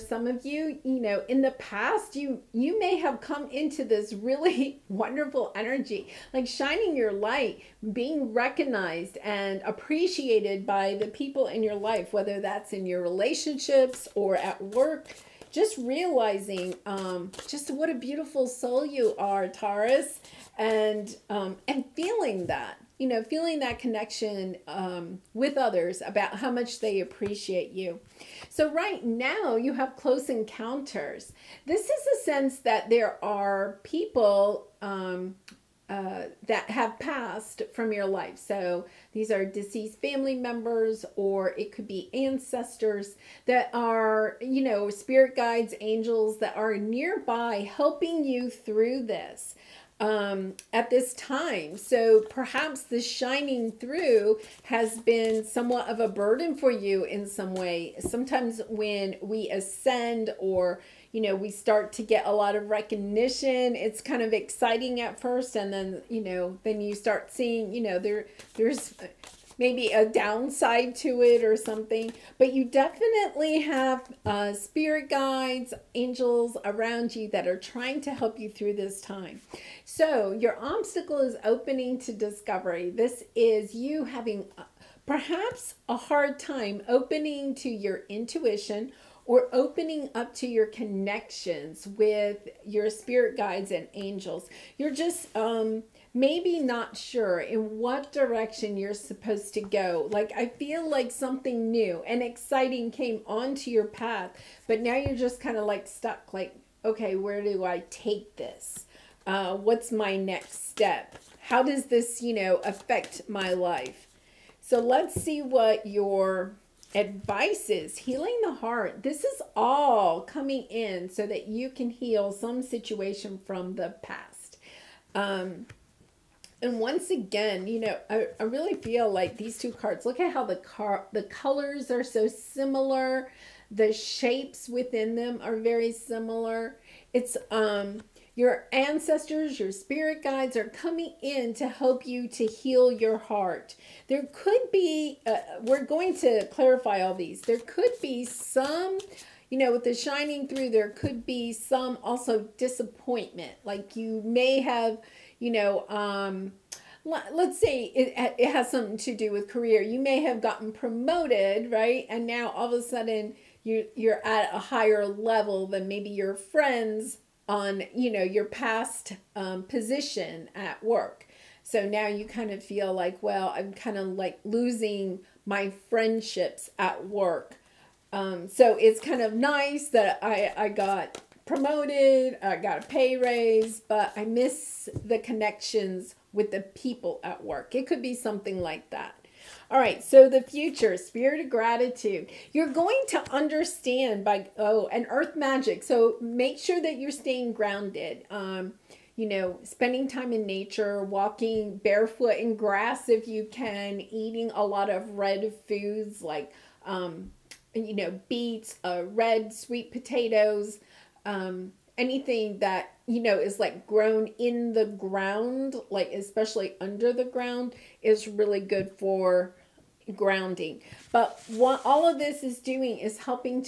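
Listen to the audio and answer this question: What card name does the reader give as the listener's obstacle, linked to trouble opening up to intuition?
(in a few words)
Opening to discovery.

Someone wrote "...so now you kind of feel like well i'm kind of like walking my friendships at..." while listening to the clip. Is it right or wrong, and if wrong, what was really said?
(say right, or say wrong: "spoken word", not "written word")
wrong: "losing", not "walking".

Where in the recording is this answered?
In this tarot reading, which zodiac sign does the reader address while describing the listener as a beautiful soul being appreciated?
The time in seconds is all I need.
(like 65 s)
19 s.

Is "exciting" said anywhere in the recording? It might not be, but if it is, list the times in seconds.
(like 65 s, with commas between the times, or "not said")
64 s, 102 s.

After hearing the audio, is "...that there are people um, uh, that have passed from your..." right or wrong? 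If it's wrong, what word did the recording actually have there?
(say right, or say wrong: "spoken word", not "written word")
right.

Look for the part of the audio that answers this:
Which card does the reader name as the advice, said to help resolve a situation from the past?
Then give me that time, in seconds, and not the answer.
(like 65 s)
117 s.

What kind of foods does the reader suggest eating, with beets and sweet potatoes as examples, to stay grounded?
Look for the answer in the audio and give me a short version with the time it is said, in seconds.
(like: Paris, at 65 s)
Red foods, at 205 s.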